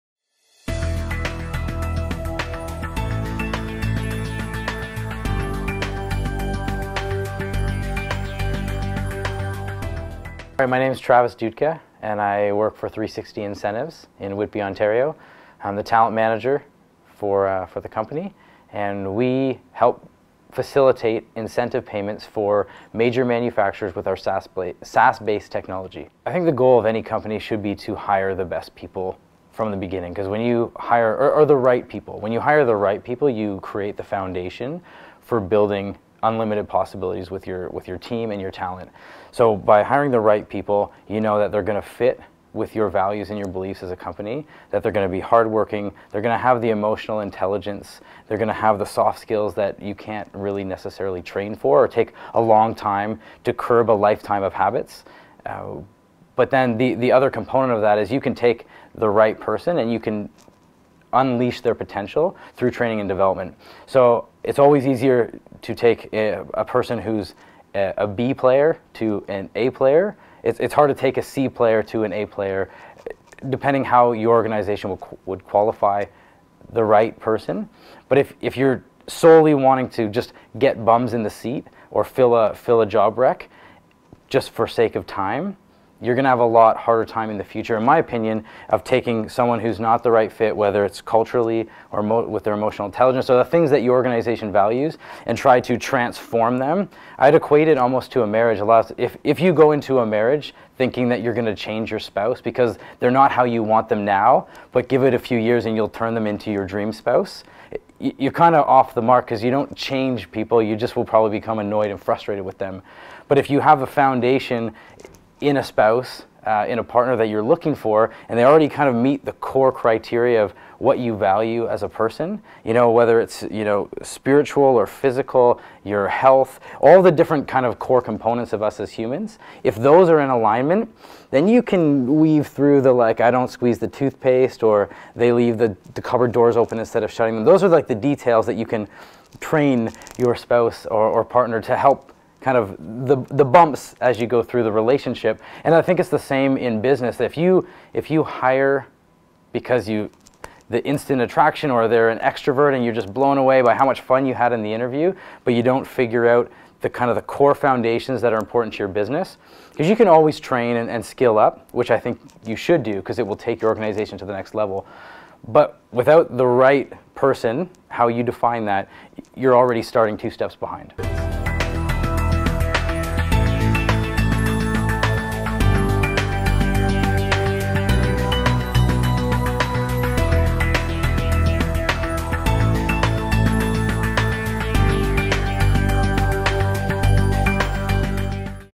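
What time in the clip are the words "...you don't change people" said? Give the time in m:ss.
1:49.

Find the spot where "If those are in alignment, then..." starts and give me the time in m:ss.
2:09.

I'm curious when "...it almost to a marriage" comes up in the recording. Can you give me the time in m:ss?
1:37.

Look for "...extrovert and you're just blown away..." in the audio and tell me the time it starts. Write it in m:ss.
2:32.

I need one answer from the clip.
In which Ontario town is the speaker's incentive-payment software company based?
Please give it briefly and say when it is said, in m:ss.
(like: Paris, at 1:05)
Whitby, at 0:14.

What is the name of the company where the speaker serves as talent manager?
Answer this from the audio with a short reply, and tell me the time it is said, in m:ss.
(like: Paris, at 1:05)
360 Incentives, at 0:12.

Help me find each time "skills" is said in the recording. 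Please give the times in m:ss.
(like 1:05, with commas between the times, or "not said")
0:49, 2:41.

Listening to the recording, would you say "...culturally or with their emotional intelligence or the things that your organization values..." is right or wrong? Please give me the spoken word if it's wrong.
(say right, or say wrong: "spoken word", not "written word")
right.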